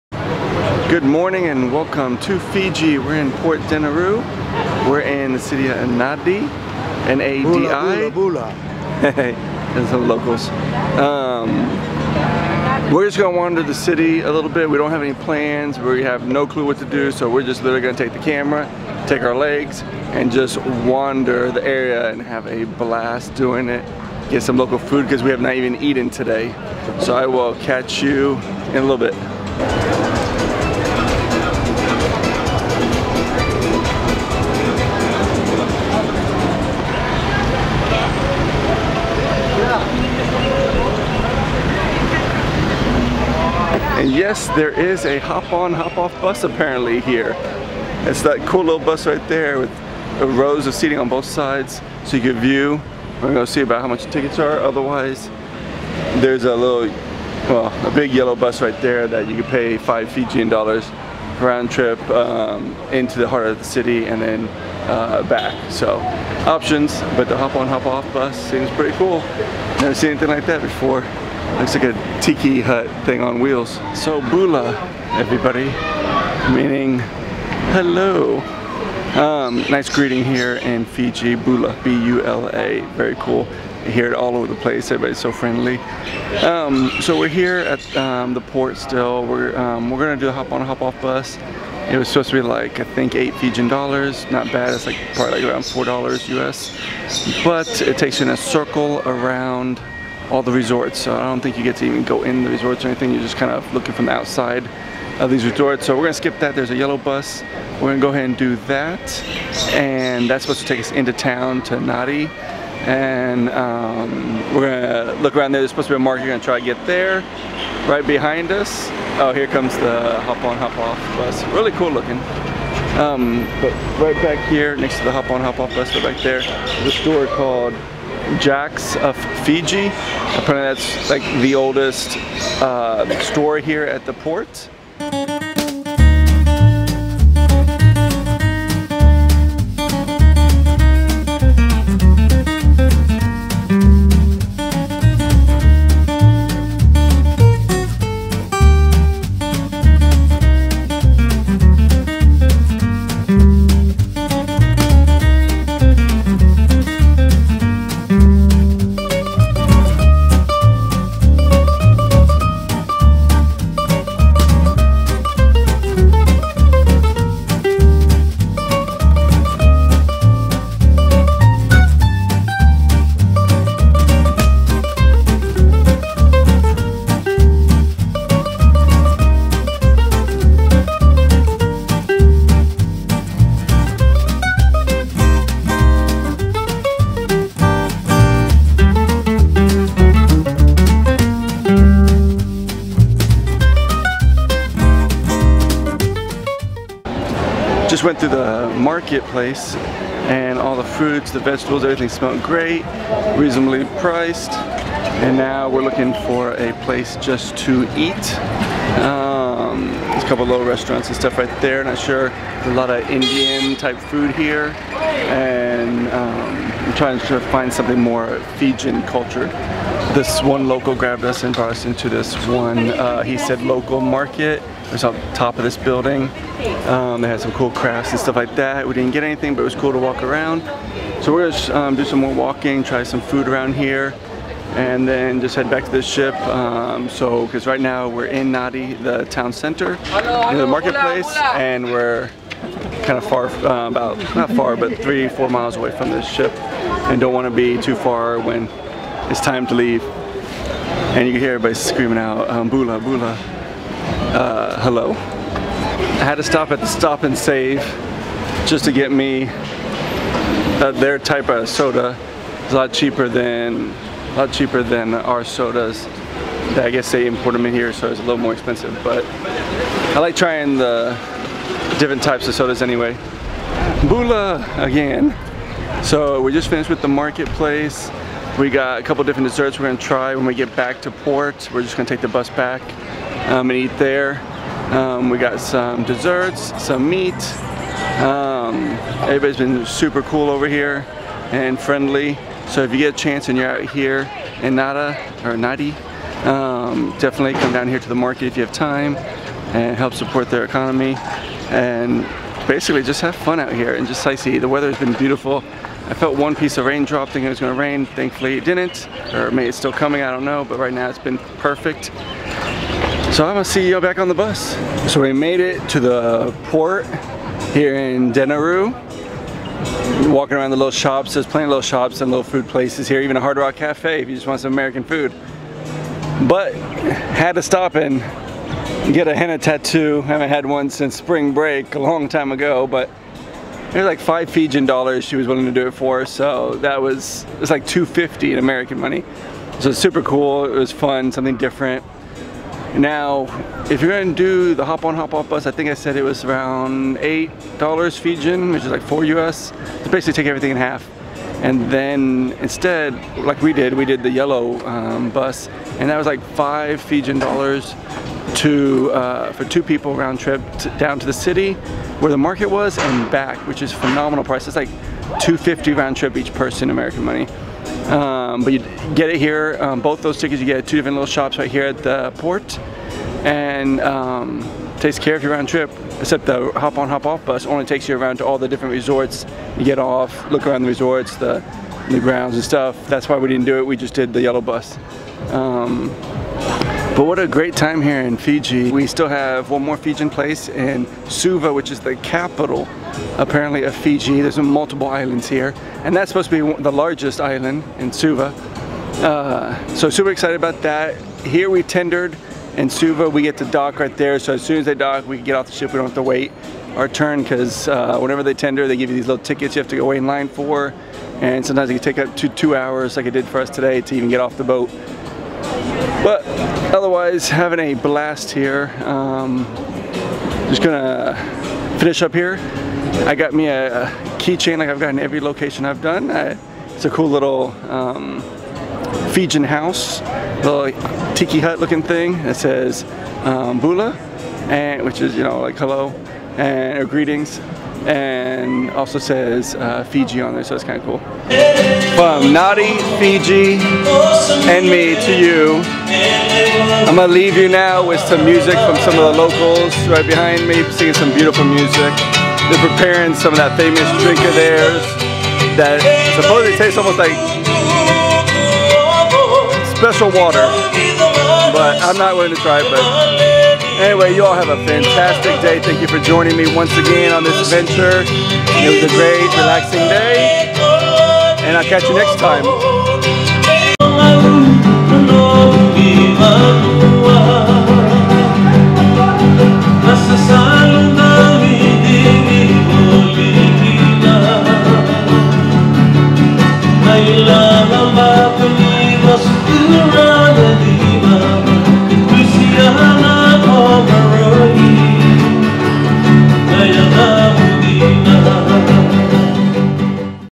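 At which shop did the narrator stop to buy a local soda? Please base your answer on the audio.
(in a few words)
Stop and Save.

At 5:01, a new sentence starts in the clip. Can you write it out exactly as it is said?
And basically just have fun out here and just sightsee.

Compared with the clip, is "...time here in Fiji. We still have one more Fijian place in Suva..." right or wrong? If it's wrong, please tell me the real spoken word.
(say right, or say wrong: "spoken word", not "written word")
right.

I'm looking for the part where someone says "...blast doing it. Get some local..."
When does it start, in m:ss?
0:22.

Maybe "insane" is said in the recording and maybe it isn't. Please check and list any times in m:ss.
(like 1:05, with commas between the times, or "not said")
not said.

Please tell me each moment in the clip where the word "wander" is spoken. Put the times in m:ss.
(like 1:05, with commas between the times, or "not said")
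0:13, 0:20.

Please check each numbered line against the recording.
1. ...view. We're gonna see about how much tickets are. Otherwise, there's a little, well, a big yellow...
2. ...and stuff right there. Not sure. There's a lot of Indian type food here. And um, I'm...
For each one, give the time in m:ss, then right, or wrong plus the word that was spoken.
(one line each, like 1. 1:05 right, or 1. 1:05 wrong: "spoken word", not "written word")
1. 0:52 right
2. 3:31 right.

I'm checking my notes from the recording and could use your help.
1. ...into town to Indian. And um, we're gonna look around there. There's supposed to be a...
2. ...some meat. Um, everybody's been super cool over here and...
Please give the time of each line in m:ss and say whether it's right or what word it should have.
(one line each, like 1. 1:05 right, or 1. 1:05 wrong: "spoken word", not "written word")
1. 1:50 wrong: "Nadi", not "Indian"
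2. 4:46 right.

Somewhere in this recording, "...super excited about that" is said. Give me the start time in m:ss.
6:40.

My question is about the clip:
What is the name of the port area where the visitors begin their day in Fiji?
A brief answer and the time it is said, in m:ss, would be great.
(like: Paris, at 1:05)
Port Denarau, at 0:03.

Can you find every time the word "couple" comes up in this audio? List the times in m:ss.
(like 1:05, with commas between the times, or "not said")
3:30, 4:39.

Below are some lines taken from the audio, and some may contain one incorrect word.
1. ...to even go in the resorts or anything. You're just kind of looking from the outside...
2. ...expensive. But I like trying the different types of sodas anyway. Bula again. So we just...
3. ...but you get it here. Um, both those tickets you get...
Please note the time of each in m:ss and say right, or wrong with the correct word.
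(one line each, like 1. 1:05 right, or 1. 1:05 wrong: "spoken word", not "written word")
1. 1:41 right
2. 4:28 right
3. 6:08 right.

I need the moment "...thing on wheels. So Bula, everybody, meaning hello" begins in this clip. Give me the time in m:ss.
1:13.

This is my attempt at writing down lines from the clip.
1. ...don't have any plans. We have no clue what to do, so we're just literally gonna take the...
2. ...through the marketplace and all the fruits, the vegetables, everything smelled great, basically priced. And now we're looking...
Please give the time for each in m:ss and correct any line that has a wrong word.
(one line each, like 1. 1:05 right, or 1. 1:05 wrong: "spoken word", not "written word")
1. 0:14 right
2. 3:18 wrong: "reasonably", not "basically".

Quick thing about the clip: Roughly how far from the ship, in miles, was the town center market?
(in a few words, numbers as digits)
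3-4 miles.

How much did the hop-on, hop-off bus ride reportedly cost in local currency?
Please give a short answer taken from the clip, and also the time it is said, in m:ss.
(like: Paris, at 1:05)
8 Fijian dollars, at 1:33.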